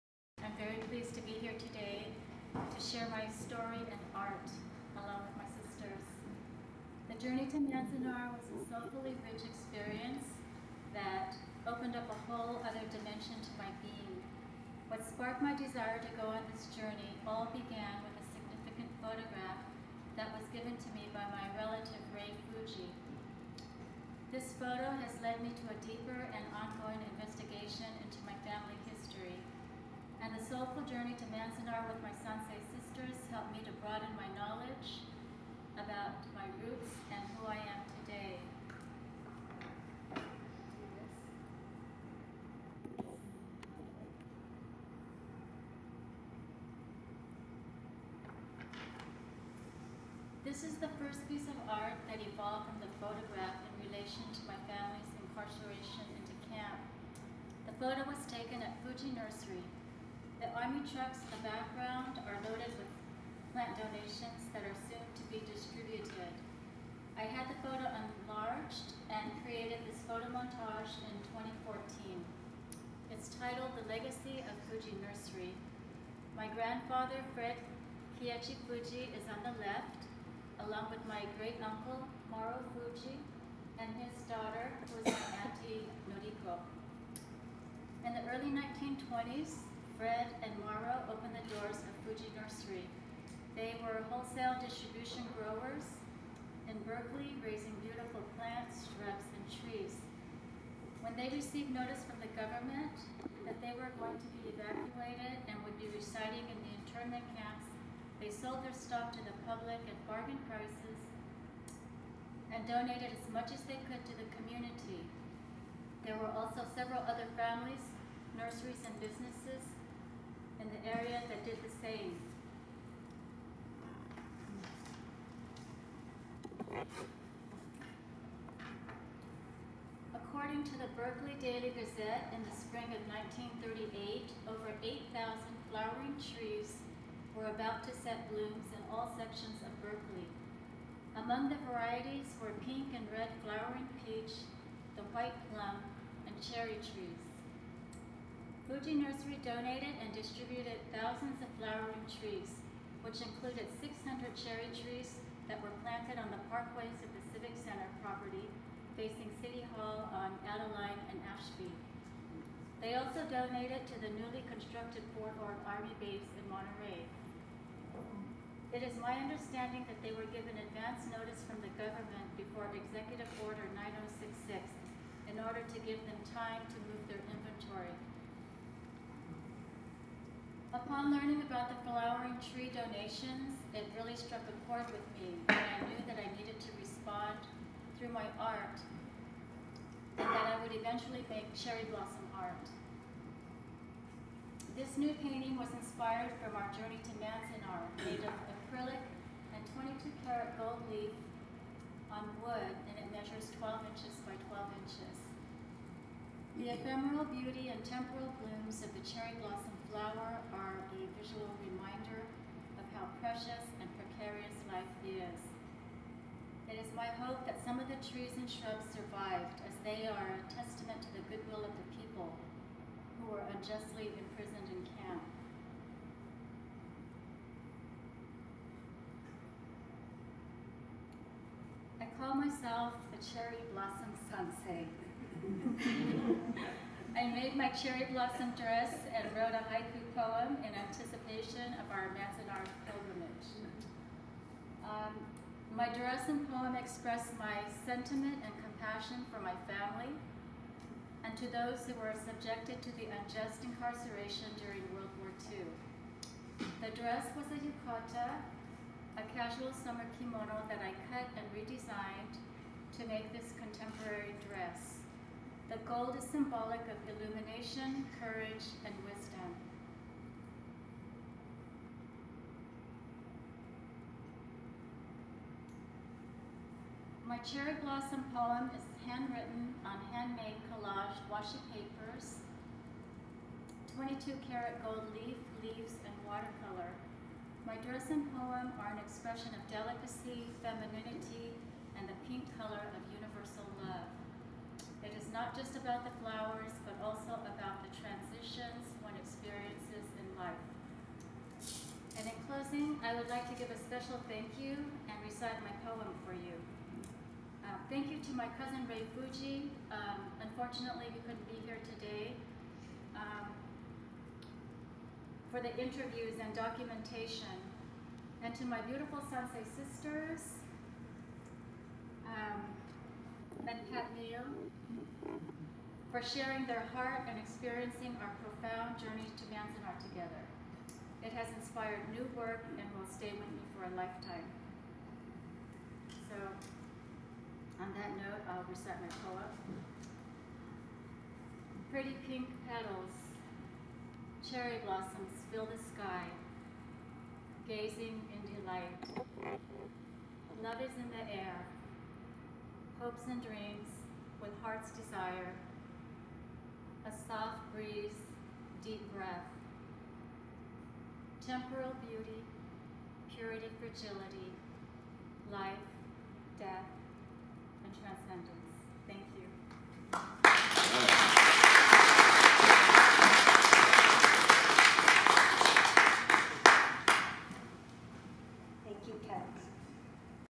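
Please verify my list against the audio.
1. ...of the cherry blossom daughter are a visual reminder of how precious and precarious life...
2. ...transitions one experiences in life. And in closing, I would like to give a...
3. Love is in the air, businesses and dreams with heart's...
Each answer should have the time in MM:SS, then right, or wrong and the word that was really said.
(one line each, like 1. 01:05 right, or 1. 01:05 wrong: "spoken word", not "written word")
1. 03:28 wrong: "flower", not "daughter"
2. 04:57 right
3. 05:50 wrong: "hopes", not "businesses".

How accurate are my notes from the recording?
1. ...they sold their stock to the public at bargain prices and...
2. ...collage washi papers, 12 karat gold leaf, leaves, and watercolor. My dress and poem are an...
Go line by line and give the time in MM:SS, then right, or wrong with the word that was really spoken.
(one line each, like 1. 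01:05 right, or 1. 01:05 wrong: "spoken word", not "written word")
1. 01:48 right
2. 04:40 wrong: "22", not "12".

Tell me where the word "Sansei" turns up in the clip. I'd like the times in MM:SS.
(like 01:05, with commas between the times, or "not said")
00:32, 05:19.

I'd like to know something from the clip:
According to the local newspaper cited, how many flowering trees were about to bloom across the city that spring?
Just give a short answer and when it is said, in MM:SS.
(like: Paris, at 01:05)
8,000, at 02:14.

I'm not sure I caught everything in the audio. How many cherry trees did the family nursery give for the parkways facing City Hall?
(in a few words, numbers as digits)
600.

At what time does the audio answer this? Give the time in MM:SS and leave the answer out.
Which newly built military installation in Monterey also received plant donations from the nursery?
02:45.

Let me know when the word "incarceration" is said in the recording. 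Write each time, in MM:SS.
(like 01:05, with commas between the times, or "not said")
00:55, 04:13.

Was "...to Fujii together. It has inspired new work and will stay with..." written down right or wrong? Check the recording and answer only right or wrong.
wrong.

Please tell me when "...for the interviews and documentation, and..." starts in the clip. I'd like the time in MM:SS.
05:15.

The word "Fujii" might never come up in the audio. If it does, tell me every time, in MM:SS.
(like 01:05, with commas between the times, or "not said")
00:22, 00:58, 01:14, 01:18, 01:22, 01:32, 02:28, 05:09.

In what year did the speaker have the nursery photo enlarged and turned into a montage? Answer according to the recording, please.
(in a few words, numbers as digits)
2014.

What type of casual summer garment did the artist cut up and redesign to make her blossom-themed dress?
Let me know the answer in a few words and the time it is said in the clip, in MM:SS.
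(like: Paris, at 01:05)
yukata, at 04:17.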